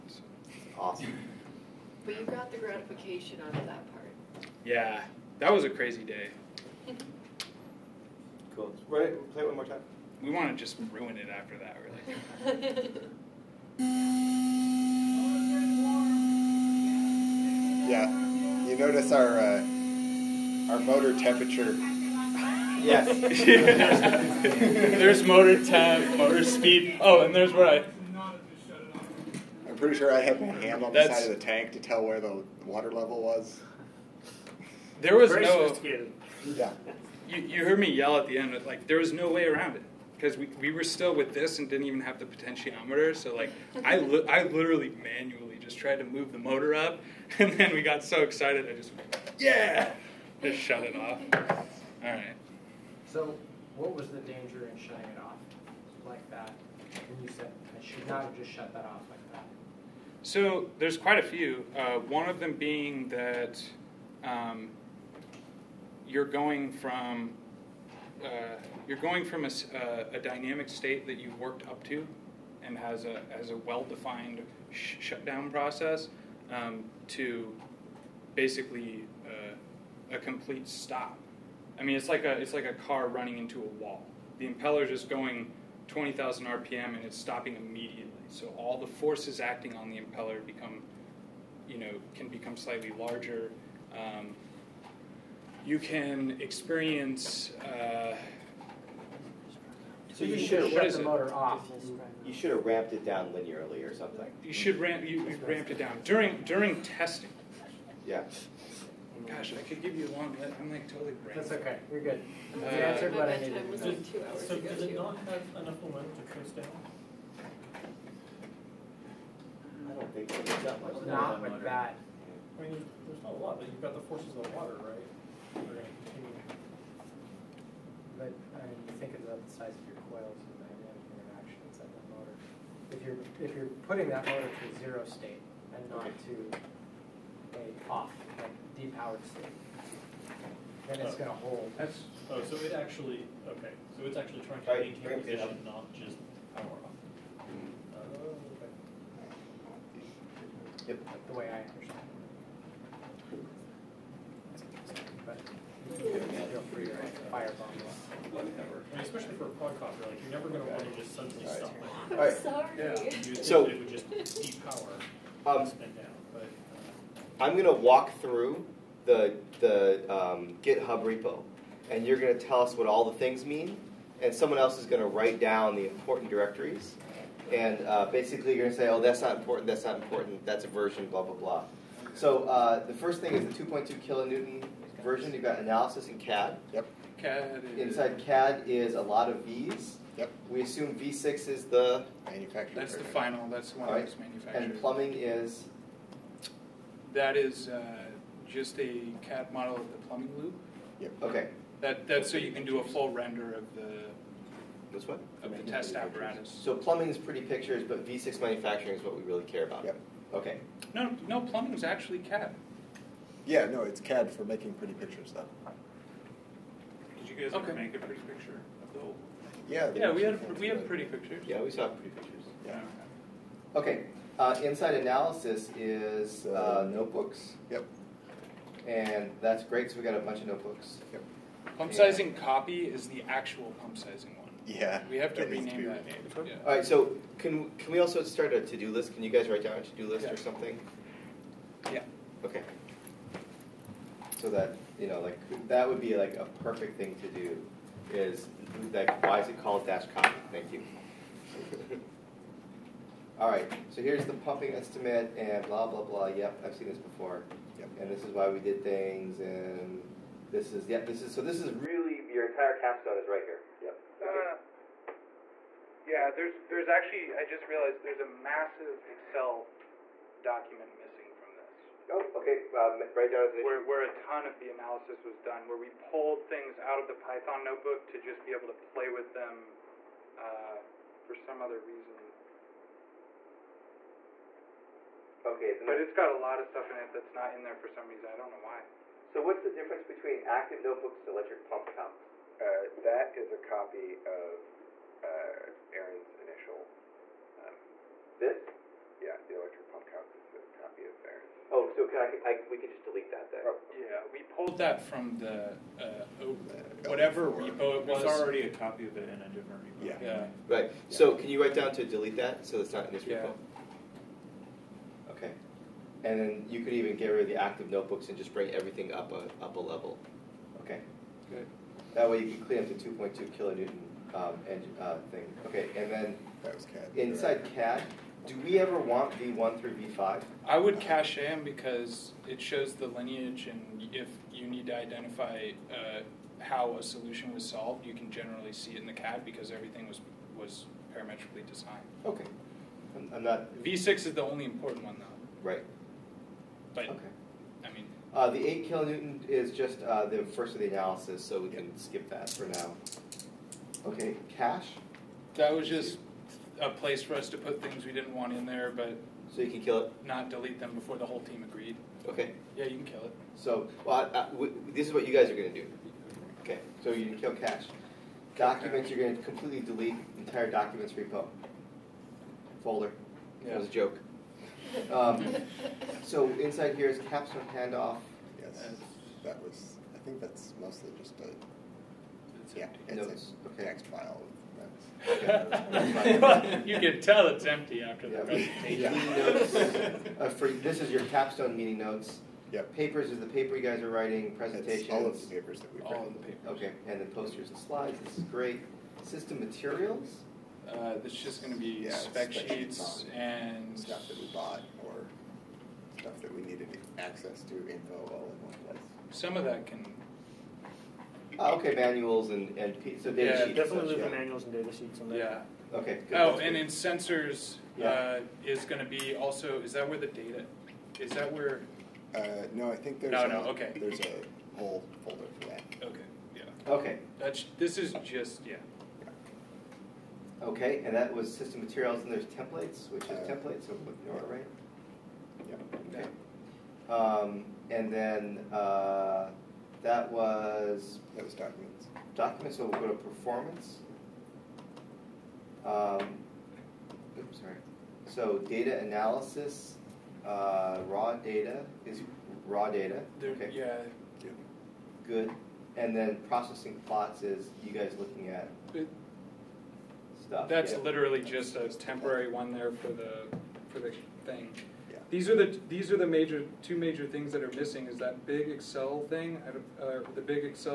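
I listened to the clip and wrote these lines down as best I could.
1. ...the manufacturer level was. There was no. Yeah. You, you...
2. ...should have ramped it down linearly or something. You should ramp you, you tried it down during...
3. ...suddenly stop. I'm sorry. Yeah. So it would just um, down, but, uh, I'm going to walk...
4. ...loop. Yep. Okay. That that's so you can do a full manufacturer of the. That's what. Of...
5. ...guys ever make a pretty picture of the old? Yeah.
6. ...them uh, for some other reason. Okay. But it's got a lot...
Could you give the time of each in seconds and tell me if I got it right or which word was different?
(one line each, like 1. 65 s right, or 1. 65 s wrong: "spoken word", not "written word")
1. 32 s wrong: "water", not "manufacturer"
2. 102 s wrong: "ramped", not "tried"
3. 161 s right
4. 200 s wrong: "render", not "manufacturer"
5. 217 s right
6. 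279 s right.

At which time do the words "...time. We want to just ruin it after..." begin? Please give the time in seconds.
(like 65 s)
9 s.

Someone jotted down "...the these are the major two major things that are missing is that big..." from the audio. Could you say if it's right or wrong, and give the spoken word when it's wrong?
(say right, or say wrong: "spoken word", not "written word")
right.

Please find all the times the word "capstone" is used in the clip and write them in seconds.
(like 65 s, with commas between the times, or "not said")
262 s, 377 s, 391 s.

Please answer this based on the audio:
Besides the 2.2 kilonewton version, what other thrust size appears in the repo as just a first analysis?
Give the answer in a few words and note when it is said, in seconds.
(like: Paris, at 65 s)
8 kilonewton, at 348 s.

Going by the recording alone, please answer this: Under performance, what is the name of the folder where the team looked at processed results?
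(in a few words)
processing plots.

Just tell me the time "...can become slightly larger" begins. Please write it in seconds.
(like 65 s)
92 s.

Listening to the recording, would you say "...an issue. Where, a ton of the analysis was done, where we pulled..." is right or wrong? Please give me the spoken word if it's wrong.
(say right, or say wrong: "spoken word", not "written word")
right.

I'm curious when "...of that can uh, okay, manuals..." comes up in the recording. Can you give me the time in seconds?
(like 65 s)
409 s.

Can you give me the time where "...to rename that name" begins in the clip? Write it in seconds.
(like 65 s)
235 s.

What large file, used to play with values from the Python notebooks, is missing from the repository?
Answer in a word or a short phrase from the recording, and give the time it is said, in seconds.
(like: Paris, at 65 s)
Excel document, at 269 s.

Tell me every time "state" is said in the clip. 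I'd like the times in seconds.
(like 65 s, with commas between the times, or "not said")
70 s, 135 s, 139 s.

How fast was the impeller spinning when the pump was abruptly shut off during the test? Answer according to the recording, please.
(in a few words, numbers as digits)
20,000 RPM.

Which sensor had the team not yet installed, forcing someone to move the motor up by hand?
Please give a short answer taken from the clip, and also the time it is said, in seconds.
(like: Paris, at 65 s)
potentiometer, at 42 s.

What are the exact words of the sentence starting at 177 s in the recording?
And uh, basically, you're going to say, oh, that's not important, that's not important, that's a version, blah, blah, blah.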